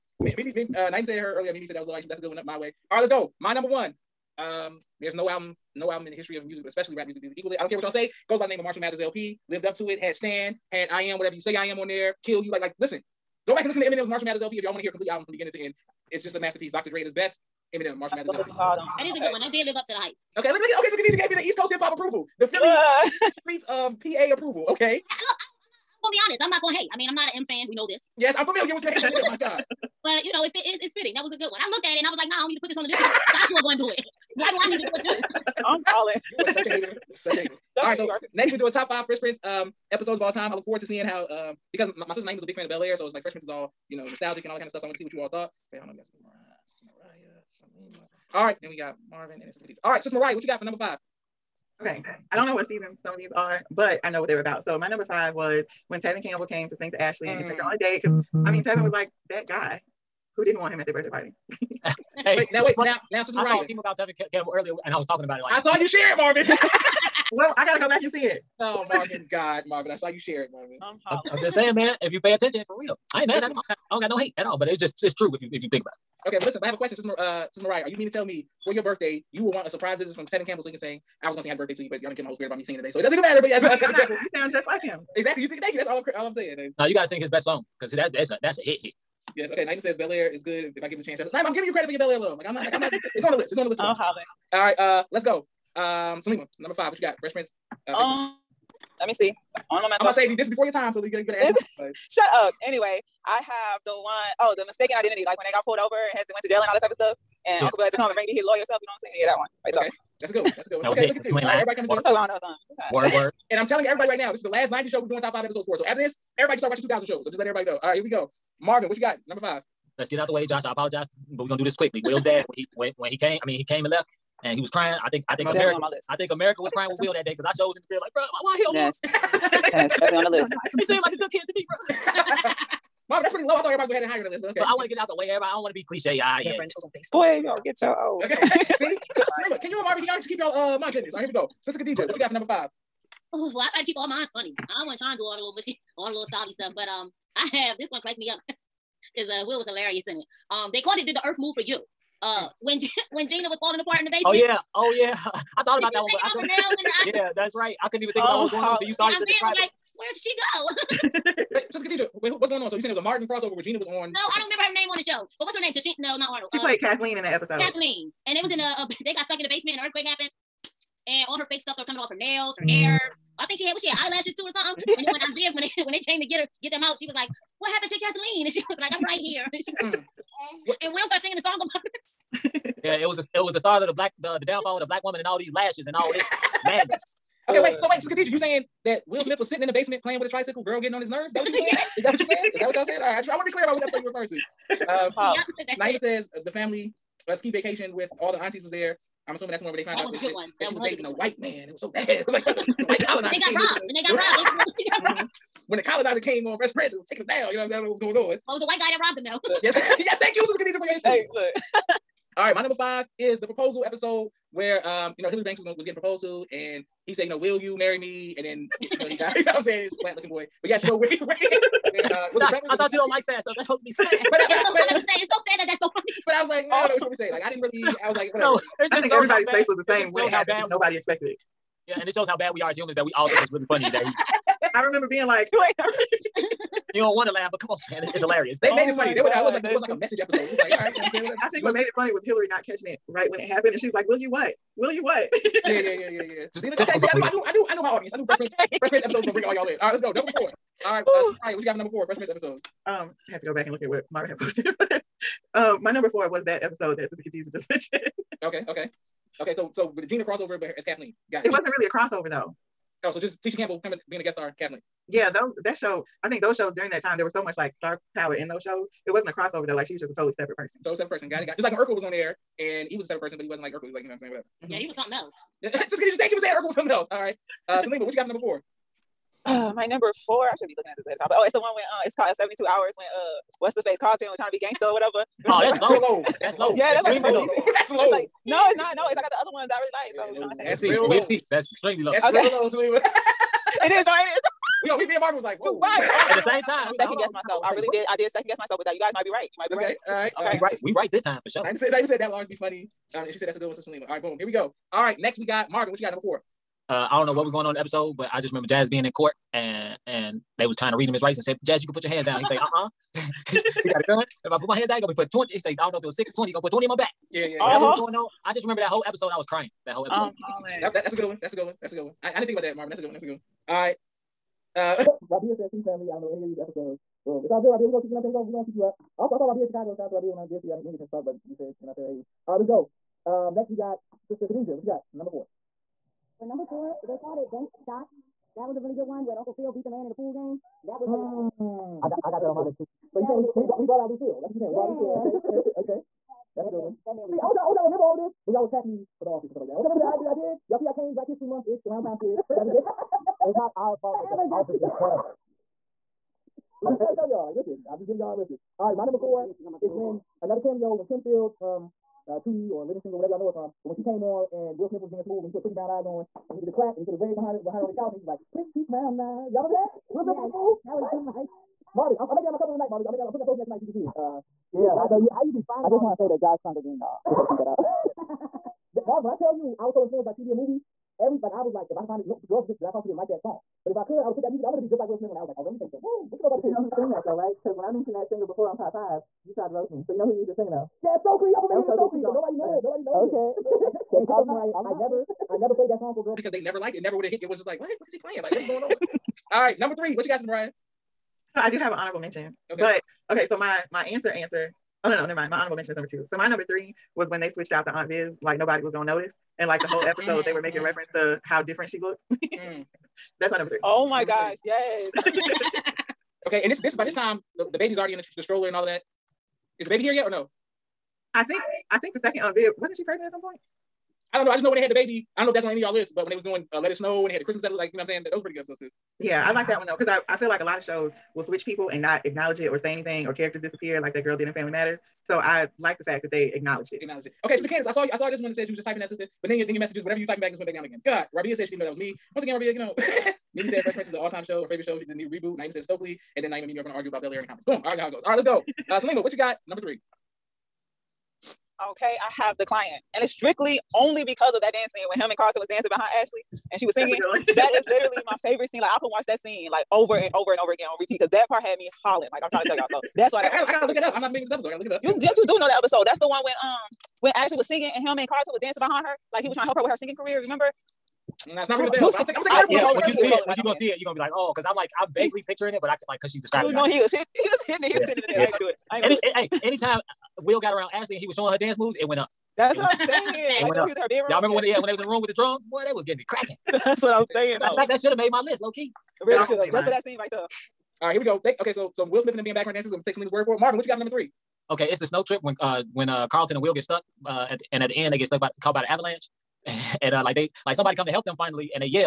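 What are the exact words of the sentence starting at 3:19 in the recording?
I'm assuming that's the one where they found that out was that, a good that, one.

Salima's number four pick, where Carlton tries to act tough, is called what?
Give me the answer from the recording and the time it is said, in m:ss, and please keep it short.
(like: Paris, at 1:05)
Seventy Two Hours, at 4:42.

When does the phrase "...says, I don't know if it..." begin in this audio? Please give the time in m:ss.
5:15.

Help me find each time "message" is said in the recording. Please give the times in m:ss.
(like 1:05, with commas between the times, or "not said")
3:59, 7:19.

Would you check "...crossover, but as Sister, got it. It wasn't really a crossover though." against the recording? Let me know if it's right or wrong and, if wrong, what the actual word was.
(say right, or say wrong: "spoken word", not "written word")
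wrong: "Kathleen", not "Sister".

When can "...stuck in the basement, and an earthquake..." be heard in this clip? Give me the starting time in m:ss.
2:49.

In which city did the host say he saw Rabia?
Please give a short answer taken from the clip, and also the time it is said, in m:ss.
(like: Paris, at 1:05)
Chicago, at 5:29.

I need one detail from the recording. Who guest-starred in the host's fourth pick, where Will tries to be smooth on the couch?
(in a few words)
Kim Fields.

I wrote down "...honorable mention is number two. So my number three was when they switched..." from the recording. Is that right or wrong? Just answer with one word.
right.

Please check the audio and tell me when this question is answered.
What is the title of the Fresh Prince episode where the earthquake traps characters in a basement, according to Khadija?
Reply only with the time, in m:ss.
2:31.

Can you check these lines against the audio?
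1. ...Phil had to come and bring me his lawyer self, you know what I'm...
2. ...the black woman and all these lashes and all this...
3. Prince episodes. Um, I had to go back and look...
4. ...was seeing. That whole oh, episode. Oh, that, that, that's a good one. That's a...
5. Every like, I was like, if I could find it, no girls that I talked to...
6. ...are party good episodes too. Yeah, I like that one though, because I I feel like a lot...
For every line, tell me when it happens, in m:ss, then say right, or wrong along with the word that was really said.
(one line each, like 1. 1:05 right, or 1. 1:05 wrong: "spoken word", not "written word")
1. 1:47 right
2. 3:04 right
3. 4:12 right
4. 5:19 wrong: "crying", not "seeing"
5. 6:21 right
6. 7:08 wrong: "pretty", not "party".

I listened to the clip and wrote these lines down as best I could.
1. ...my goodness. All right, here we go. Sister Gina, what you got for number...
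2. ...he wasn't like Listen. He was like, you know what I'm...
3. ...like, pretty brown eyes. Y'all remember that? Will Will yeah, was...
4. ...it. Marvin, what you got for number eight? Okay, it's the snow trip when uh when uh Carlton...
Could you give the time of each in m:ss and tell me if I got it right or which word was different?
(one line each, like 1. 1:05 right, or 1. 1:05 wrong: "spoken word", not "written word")
1. 2:20 wrong: "Khadija", not "Gina"
2. 4:33 wrong: "Urkel", not "Listen"
3. 6:08 wrong: "Smith", not "Will"
4. 8:13 wrong: "three", not "eight".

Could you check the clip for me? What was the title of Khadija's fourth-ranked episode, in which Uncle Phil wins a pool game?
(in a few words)
Banks Shot.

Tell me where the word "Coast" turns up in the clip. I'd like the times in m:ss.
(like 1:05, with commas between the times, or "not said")
0:21.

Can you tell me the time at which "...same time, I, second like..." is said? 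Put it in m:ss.
4:56.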